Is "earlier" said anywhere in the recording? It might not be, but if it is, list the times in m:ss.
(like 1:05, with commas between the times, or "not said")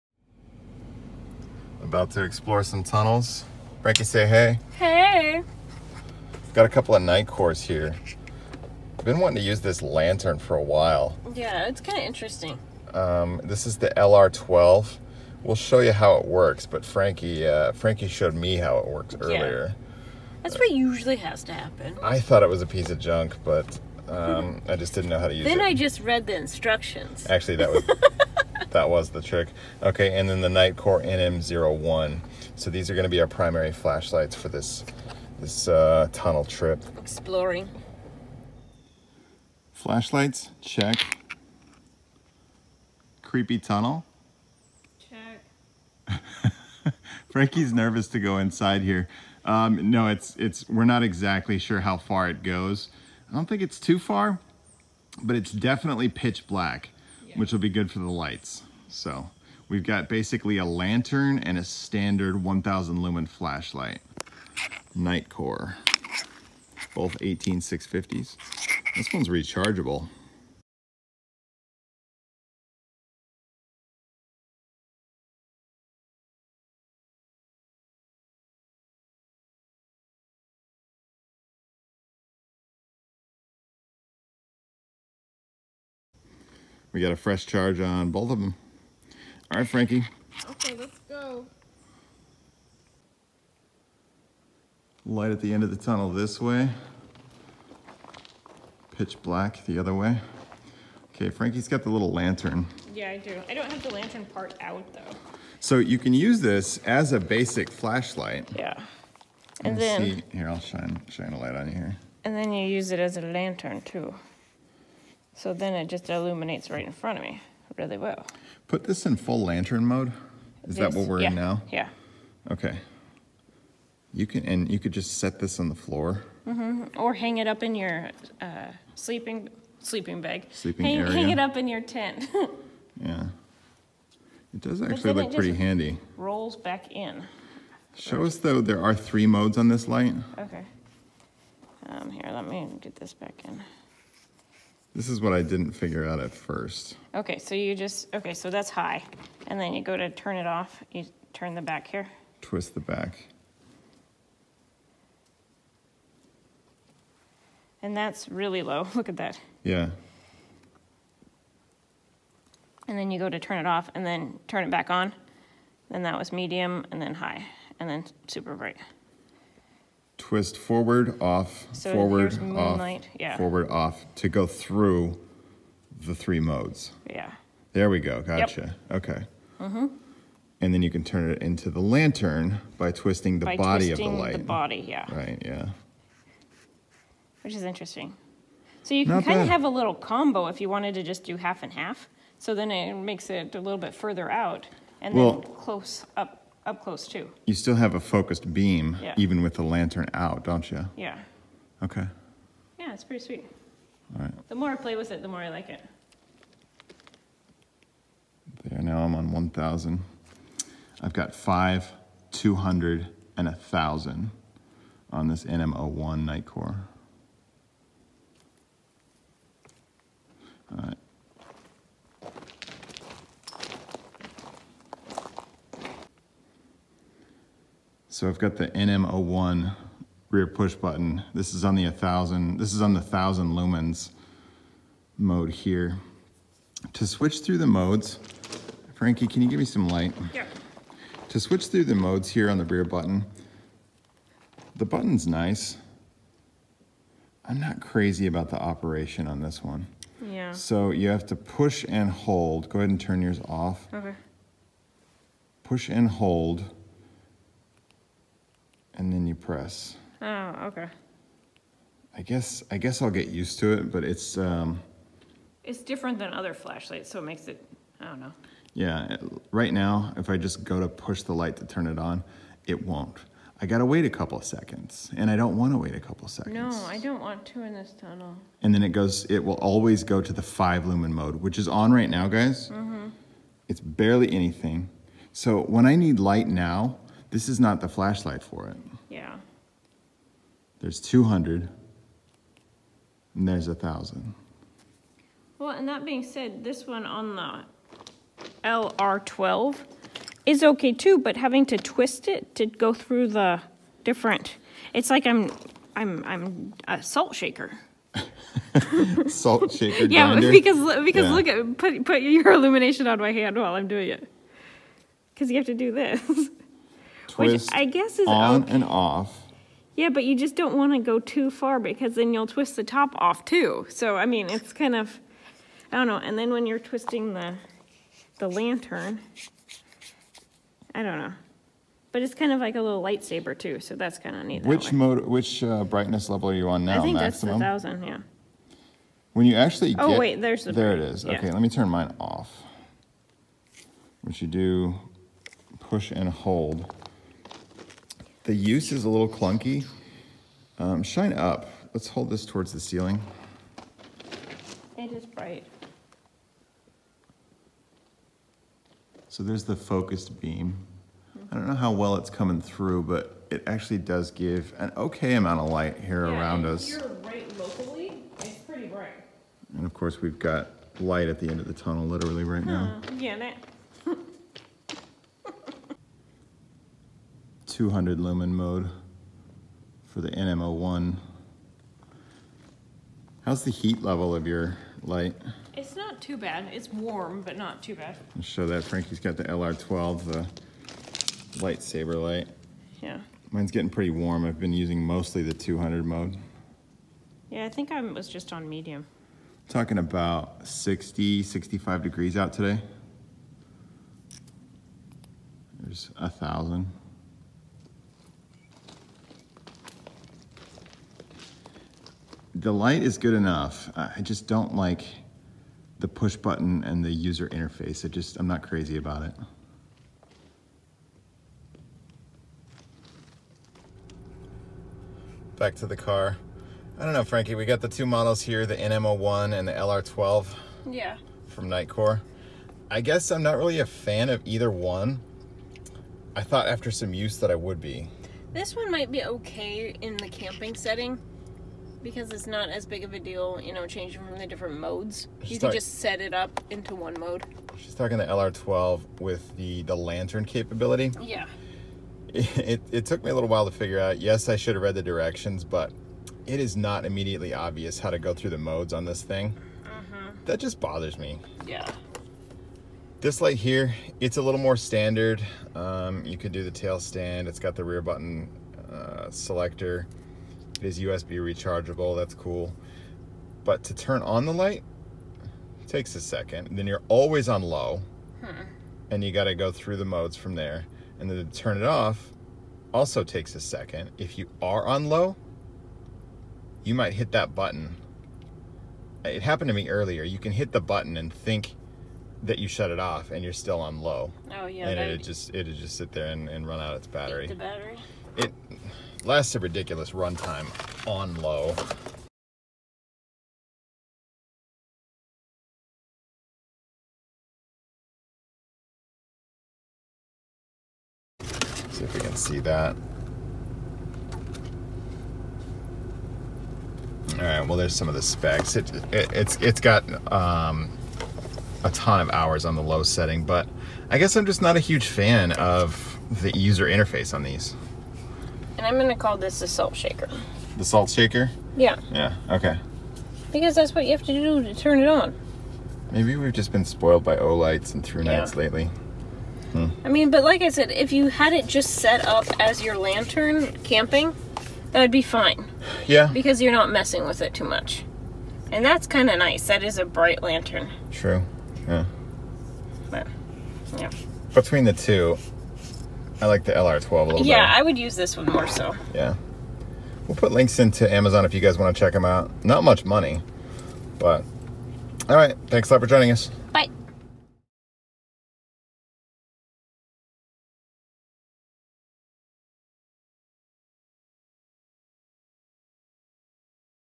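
0:19, 8:09.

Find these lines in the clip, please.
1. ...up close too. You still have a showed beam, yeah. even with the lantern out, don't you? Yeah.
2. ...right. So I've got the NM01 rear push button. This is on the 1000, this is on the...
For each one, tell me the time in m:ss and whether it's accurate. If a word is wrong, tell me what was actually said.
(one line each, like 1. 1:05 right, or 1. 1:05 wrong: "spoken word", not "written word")
1. 3:16 wrong: "focused", not "showed"
2. 3:40 right.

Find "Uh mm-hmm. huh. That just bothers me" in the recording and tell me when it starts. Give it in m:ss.
7:39.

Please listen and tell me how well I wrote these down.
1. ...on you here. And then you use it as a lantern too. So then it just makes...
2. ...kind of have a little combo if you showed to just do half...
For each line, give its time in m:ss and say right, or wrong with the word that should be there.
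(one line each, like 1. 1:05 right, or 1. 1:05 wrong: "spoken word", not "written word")
1. 1:51 wrong: "illuminates", not "makes"
2. 3:09 wrong: "wanted", not "showed".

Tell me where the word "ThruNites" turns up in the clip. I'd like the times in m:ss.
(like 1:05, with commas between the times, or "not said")
8:58.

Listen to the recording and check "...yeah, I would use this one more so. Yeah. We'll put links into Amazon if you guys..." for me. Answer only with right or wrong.
right.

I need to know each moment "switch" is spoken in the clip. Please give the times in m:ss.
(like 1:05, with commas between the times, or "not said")
3:57, 4:01.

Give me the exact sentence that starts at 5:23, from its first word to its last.
So I mean, it's kind of I don't know.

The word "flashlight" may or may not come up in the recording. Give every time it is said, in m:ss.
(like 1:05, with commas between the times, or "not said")
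0:33, 0:39, 1:03, 1:47, 4:26, 4:47.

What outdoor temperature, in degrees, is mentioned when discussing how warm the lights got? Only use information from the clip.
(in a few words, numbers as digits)
65.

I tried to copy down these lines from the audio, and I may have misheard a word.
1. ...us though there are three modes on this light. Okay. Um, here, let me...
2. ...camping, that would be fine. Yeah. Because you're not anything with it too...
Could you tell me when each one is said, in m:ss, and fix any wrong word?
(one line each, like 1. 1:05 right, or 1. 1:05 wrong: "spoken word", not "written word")
1. 2:18 right
2. 9:03 wrong: "messing", not "anything".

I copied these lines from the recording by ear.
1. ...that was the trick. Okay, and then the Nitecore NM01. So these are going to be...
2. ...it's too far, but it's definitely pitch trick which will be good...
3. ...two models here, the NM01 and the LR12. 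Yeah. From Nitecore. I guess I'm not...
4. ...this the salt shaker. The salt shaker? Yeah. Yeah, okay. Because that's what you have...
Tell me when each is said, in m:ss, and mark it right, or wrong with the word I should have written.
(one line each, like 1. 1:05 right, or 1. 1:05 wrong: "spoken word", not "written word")
1. 0:28 right
2. 0:53 wrong: "black", not "trick"
3. 7:07 right
4. 8:49 right.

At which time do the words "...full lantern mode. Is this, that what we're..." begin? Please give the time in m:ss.
1:59.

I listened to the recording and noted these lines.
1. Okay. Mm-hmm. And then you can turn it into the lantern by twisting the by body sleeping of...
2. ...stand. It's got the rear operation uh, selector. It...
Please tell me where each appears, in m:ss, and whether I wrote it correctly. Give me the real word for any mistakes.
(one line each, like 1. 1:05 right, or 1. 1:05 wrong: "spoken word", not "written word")
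1. 2:59 wrong: "twisting", not "sleeping"
2. 7:46 wrong: "button", not "operation".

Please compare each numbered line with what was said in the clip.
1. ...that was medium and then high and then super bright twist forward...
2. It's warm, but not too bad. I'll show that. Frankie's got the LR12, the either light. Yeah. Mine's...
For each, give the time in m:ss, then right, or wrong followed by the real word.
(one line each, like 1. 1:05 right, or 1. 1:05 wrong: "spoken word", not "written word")
1. 2:46 right
2. 6:26 wrong: "lightsaber", not "either".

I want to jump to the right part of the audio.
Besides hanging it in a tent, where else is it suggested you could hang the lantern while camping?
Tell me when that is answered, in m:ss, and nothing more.
2:09.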